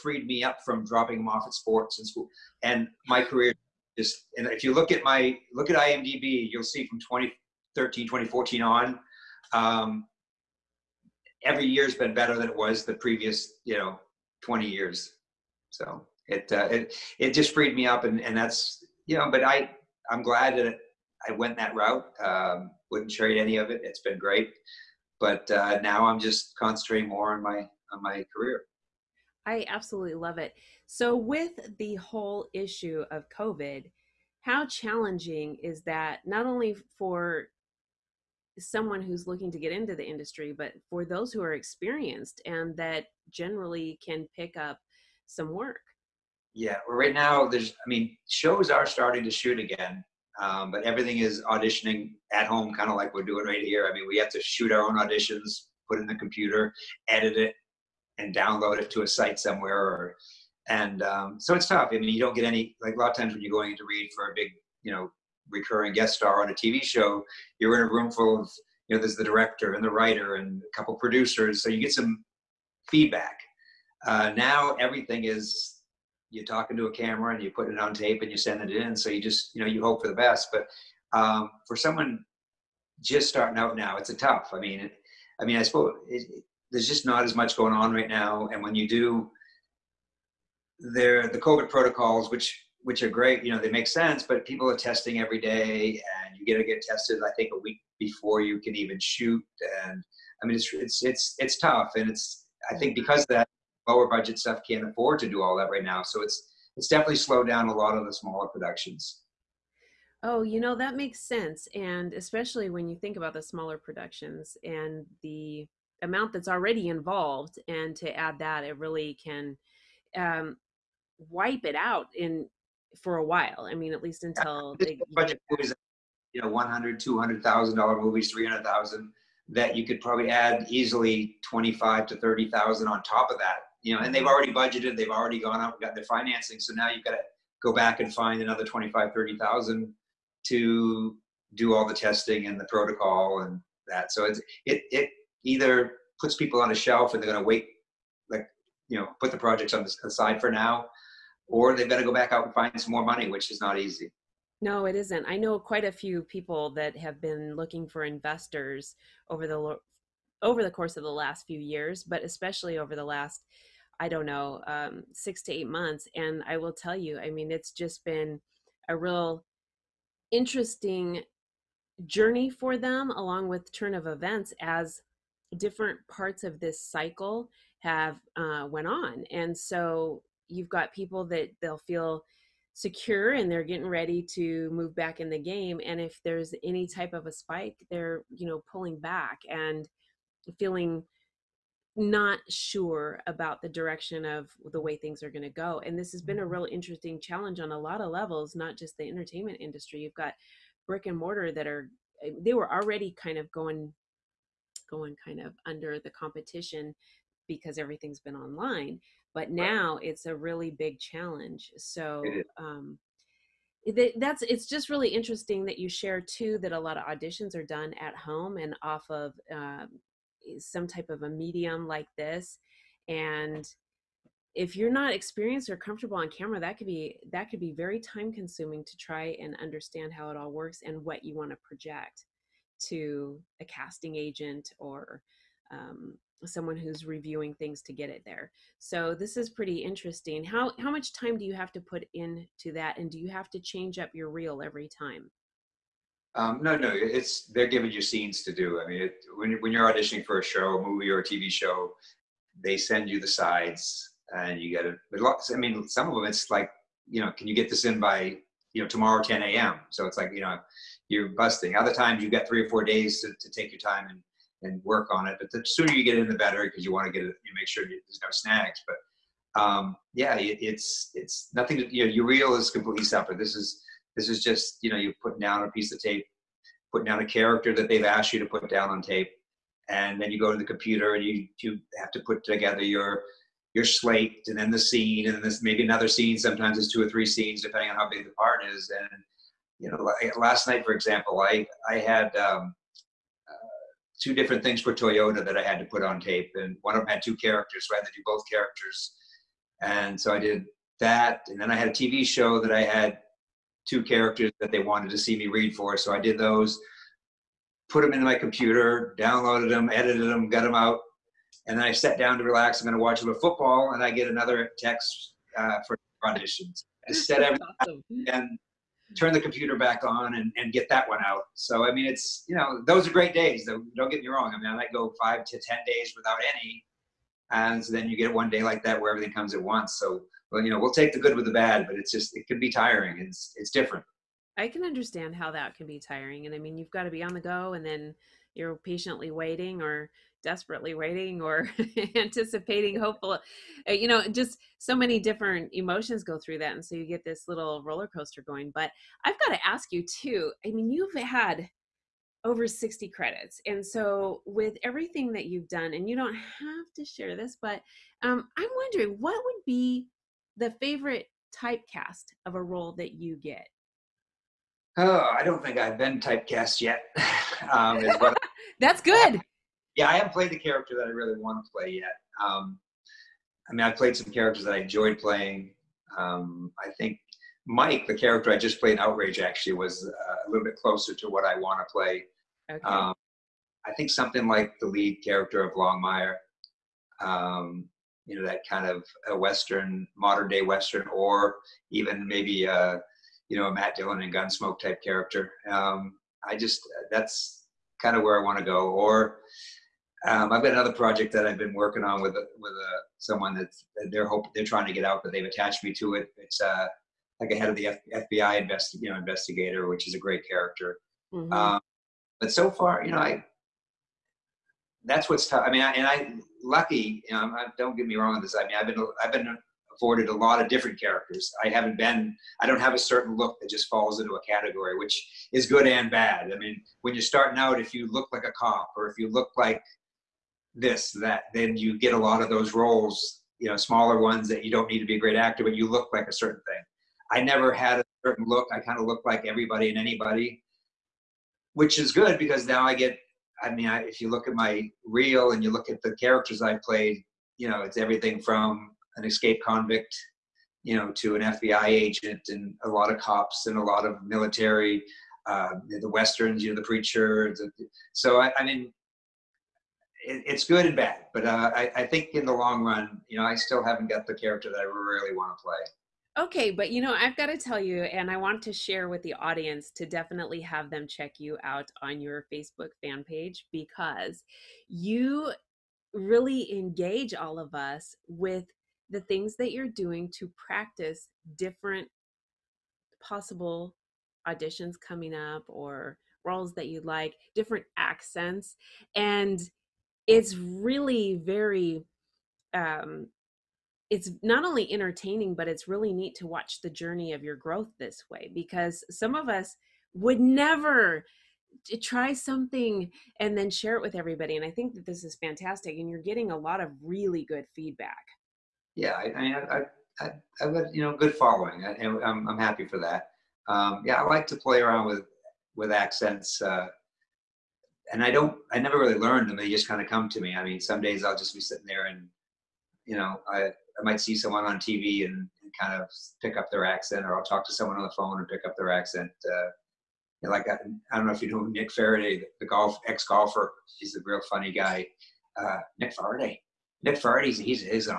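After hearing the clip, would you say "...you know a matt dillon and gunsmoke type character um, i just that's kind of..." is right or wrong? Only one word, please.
right.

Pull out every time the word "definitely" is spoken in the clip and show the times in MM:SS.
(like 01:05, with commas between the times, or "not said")
01:46, 07:50.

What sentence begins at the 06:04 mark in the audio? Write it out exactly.
Oh, I don't think I've been typecast yet.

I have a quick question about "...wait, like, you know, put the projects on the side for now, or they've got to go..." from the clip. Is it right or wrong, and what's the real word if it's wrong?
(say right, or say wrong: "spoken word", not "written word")
right.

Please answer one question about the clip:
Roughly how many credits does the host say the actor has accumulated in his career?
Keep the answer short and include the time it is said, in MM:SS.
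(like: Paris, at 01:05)
Over 60, at 05:52.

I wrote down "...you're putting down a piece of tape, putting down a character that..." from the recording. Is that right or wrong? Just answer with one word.
right.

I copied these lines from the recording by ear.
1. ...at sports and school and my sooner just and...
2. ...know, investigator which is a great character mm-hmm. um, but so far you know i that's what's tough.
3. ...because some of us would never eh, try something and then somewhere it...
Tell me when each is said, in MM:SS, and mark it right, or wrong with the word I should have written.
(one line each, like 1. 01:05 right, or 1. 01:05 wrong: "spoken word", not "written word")
1. 00:01 wrong: "career", not "sooner"
2. 06:49 right
3. 08:18 wrong: "share", not "somewhere".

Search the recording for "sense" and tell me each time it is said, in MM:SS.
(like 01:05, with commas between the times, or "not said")
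01:33, 01:51.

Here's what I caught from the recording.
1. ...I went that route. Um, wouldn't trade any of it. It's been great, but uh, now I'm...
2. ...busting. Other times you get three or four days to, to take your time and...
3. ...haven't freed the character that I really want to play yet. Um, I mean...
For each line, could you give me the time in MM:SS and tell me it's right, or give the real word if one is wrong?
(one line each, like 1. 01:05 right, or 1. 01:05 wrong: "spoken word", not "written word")
1. 00:21 right
2. 04:21 right
3. 06:10 wrong: "played", not "freed".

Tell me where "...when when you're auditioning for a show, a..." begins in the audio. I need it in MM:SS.
04:09.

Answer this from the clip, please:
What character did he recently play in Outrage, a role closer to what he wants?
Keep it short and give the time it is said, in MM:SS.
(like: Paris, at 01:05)
Mike, at 06:17.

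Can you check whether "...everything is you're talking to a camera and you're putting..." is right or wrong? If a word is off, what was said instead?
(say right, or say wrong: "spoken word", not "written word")
right.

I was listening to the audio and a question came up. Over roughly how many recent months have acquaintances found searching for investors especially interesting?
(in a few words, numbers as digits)
6 to 8 months.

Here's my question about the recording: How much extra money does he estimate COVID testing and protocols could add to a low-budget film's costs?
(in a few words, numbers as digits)
25,000 to 30,000 dollars.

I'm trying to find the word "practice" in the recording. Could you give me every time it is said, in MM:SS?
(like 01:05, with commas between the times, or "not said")
08:00.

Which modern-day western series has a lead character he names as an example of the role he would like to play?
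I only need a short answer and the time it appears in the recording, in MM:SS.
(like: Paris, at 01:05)
Longmire, at 06:25.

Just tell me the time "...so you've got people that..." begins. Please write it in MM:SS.
02:59.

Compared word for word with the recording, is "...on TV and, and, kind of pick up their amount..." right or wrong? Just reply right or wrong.
wrong.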